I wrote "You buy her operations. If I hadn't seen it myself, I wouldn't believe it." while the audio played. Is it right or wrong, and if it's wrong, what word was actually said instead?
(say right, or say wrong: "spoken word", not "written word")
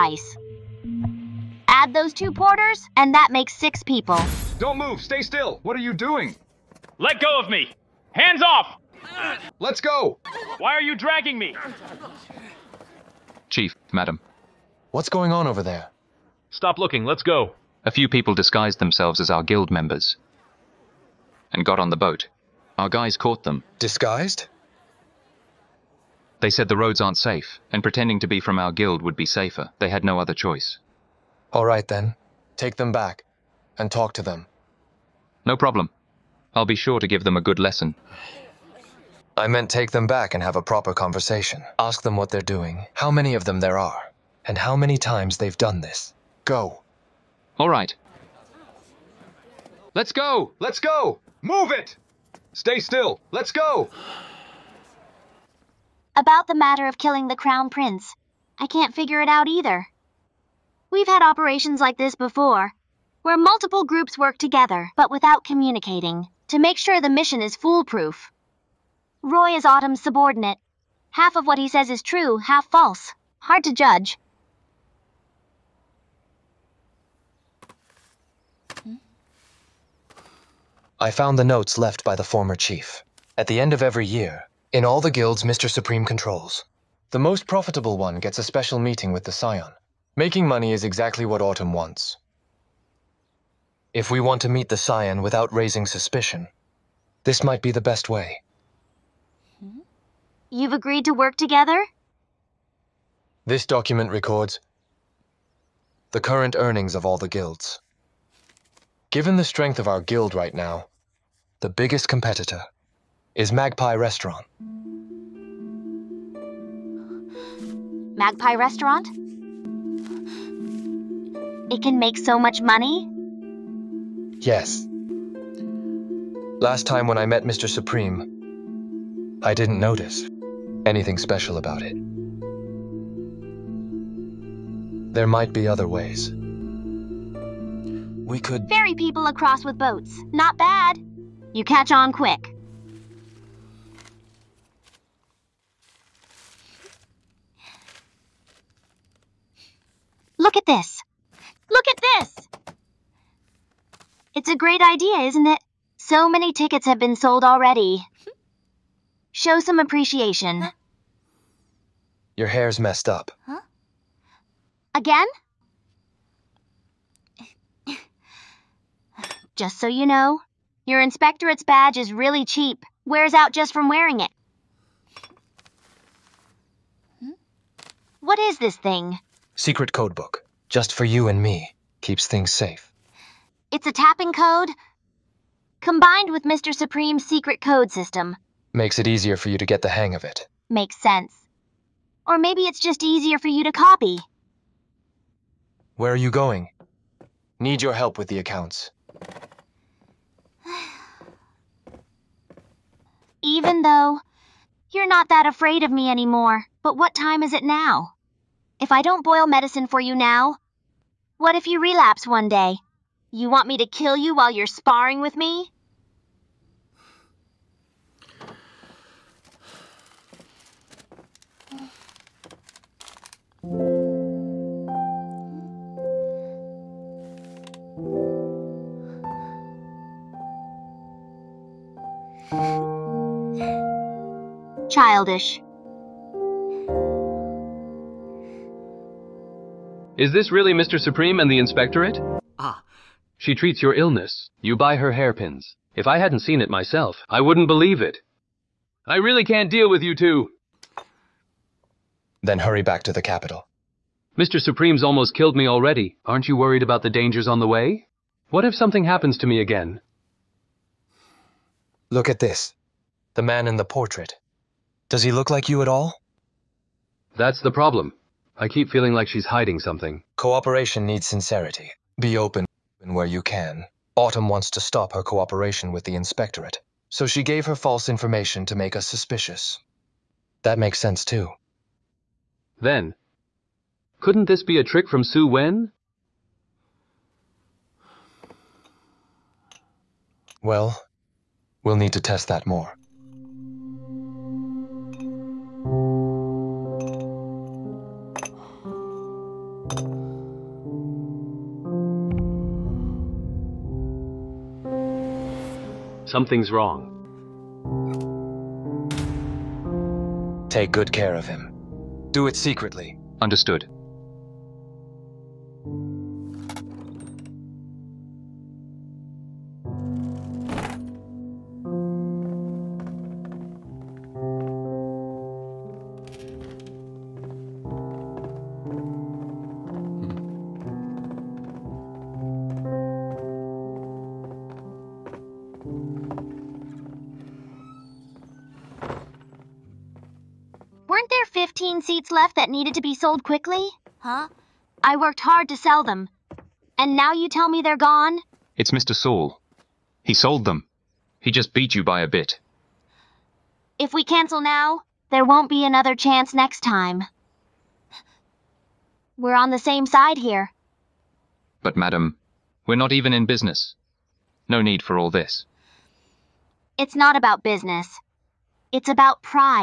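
wrong: "hairpins", not "operations".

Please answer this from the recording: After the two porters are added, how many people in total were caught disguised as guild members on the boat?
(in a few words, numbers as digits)
6.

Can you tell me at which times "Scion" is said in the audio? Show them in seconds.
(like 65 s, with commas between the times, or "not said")
89 s, 94 s.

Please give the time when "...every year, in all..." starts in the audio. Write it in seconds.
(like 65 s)
83 s.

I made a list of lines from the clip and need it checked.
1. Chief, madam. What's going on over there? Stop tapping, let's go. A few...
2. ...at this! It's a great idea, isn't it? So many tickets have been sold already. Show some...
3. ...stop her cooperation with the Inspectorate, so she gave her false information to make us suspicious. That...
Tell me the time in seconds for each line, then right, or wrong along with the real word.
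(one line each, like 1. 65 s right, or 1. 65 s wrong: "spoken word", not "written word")
1. 13 s wrong: "looking", not "tapping"
2. 151 s right
3. 274 s right.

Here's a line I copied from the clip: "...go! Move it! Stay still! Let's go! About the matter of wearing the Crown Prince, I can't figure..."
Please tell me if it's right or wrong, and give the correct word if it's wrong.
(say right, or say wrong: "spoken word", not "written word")
wrong: "killing", not "wearing".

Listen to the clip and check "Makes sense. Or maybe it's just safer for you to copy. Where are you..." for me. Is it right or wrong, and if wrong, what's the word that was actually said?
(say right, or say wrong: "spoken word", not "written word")
wrong: "easier", not "safer".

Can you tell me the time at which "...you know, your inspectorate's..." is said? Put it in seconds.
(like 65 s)
169 s.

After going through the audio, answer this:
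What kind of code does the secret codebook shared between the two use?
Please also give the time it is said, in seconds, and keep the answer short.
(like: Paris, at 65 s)
Tapping code, at 183 s.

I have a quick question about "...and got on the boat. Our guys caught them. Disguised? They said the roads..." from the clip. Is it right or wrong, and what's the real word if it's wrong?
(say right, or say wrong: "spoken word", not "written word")
right.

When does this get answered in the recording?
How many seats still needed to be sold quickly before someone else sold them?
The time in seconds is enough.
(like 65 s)
341 s.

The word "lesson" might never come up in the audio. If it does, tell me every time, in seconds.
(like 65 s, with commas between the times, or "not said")
37 s.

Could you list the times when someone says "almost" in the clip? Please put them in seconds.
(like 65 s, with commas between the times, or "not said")
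255 s.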